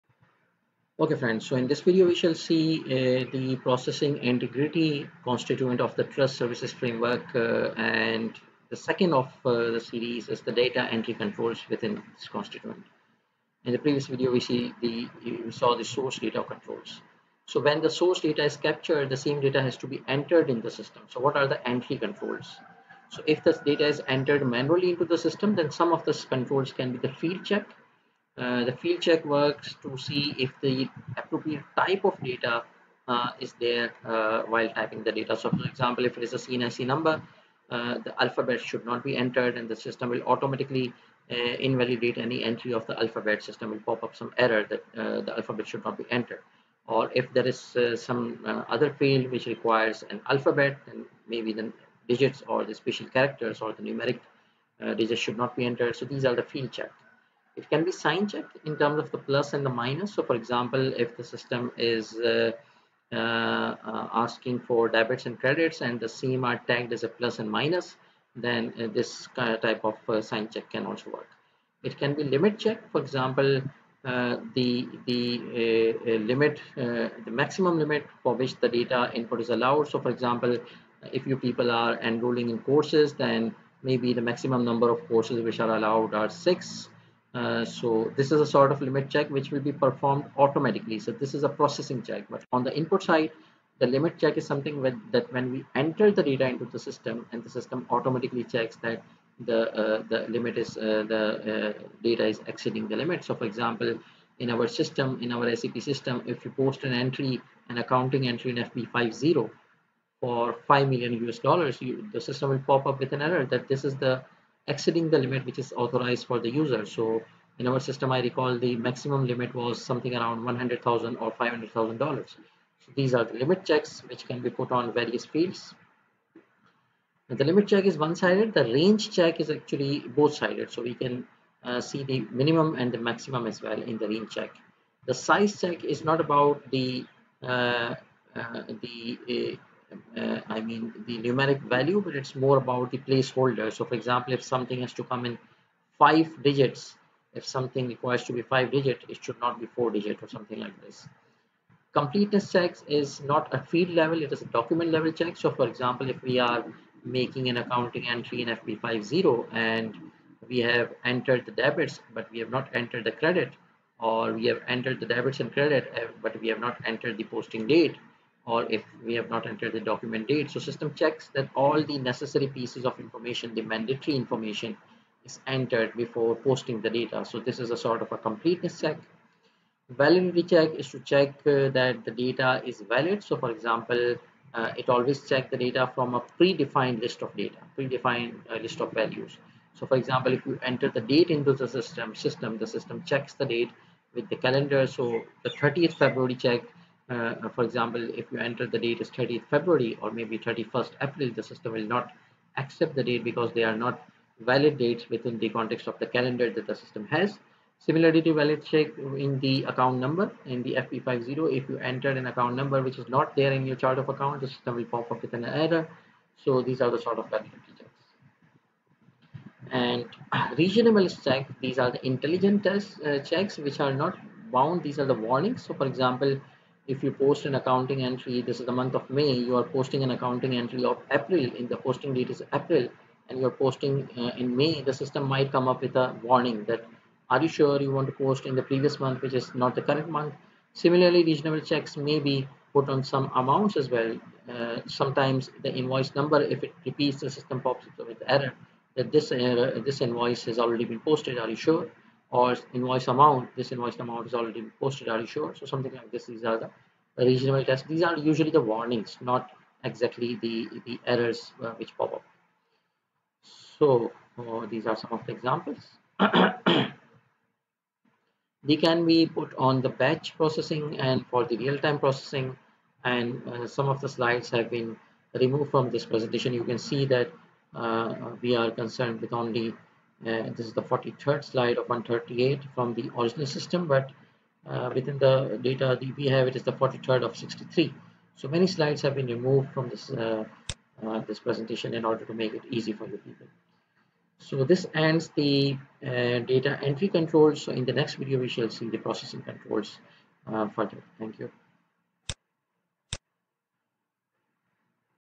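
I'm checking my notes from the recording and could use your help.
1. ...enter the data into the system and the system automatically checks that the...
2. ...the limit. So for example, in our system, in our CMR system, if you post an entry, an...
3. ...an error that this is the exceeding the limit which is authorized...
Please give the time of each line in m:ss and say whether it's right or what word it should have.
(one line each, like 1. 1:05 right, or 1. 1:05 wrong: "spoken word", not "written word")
1. 1:35 right
2. 1:42 wrong: "SAP", not "CMR"
3. 1:53 right.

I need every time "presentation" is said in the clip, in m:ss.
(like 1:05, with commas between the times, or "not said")
4:36, 4:51.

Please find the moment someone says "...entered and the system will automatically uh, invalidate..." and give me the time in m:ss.
0:39.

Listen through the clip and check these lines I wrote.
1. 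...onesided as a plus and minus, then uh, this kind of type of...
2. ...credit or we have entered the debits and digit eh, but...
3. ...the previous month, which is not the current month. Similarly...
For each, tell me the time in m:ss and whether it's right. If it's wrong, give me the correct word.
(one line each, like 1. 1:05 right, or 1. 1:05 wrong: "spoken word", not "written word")
1. 1:06 wrong: "tagged", not "onesided"
2. 2:43 wrong: "credit", not "digit"
3. 3:58 right.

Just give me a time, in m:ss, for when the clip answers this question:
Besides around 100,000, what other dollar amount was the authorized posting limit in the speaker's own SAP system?
2:01.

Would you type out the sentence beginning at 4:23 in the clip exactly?
So uh, these are some of the examples.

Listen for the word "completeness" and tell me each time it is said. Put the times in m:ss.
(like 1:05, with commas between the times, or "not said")
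2:31, 2:58.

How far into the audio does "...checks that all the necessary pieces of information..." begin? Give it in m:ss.
2:50.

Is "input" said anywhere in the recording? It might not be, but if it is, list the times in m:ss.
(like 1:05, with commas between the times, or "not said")
1:19, 1:32.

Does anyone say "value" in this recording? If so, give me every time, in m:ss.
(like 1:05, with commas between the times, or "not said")
2:21, 3:08.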